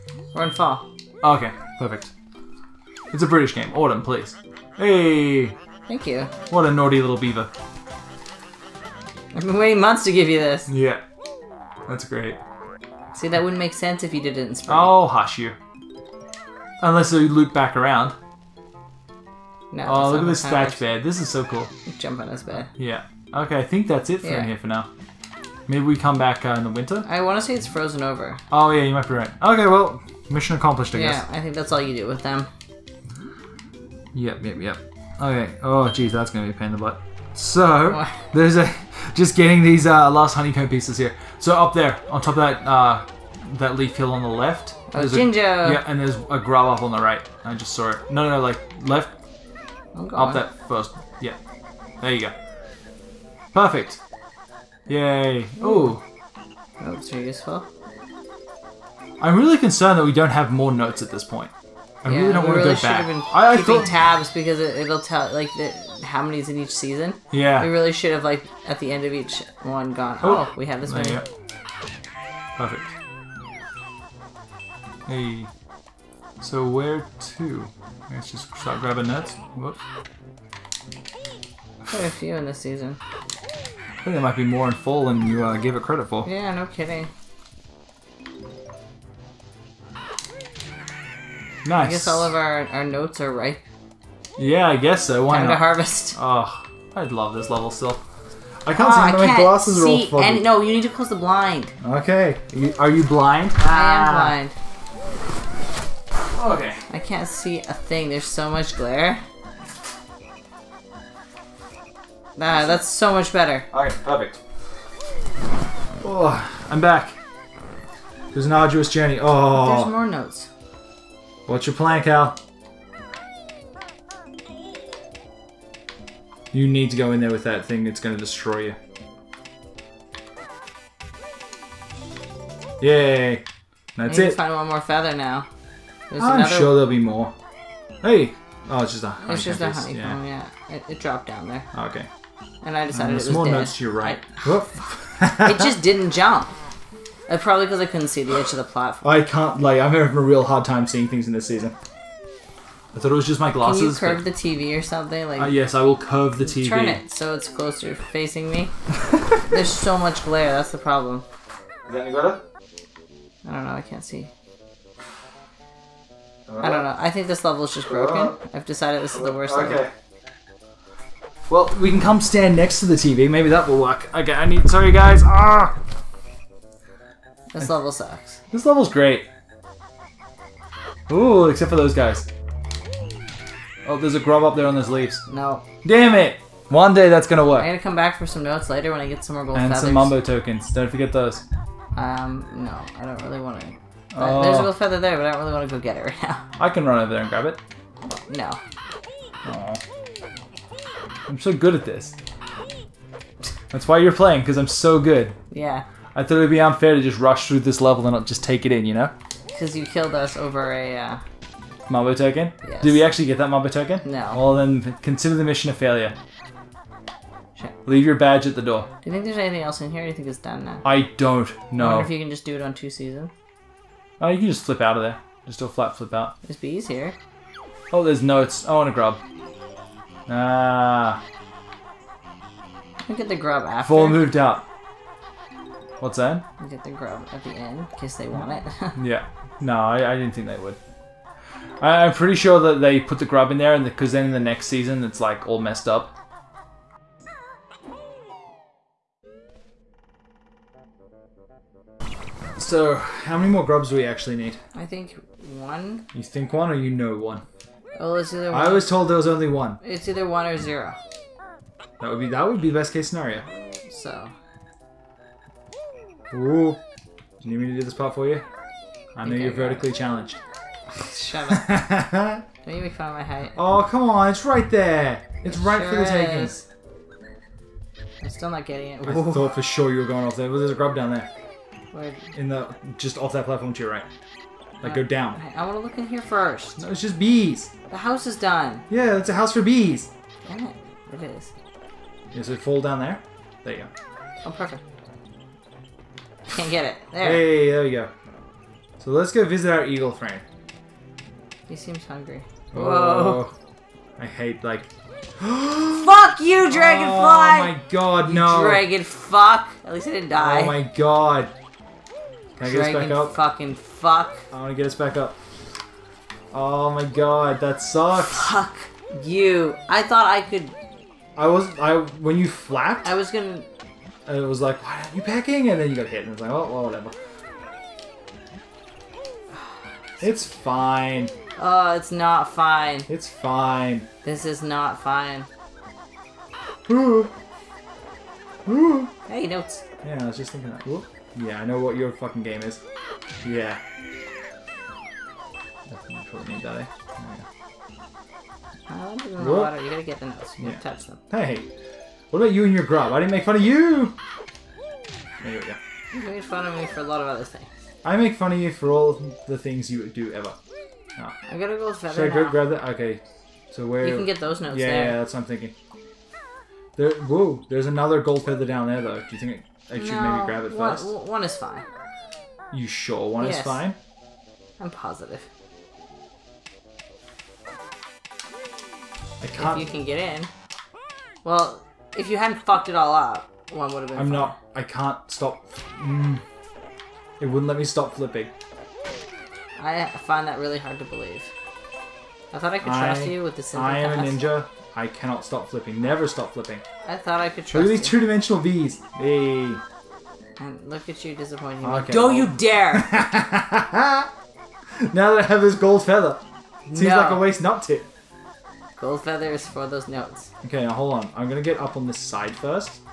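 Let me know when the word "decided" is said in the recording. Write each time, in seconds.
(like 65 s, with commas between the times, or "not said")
142 s, 168 s.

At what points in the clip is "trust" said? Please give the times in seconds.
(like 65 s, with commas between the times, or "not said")
392 s, 397 s.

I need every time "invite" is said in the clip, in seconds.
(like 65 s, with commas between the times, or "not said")
not said.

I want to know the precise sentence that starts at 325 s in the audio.
And then you got hit, and it's like, oh, well, whatever.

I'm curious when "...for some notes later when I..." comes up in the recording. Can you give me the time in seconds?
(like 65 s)
188 s.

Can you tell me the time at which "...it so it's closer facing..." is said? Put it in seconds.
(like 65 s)
156 s.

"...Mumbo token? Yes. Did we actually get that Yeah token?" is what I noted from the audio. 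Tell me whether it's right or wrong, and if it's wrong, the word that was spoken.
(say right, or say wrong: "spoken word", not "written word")
wrong: "Mumbo", not "Yeah".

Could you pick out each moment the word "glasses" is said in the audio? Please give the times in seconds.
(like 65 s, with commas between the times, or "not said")
99 s, 153 s.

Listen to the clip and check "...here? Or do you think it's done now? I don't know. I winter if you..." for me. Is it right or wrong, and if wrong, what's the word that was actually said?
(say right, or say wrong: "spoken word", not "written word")
wrong: "wonder", not "winter".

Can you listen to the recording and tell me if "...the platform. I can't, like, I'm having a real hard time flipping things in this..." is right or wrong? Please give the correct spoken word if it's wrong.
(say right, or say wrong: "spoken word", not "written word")
wrong: "seeing", not "flipping".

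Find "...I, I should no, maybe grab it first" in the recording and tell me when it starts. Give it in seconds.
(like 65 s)
369 s.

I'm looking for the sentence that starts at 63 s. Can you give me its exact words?
I, I thought tabs because it, will tell like the, how many's in each season.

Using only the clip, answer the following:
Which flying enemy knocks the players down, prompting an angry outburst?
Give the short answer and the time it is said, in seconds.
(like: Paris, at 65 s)
Dragonfly, at 306 s.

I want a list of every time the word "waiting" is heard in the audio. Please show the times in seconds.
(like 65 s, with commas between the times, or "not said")
9 s.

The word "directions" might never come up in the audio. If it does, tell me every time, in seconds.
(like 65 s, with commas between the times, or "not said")
not said.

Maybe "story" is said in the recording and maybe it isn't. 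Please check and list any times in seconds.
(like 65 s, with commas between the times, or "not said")
not said.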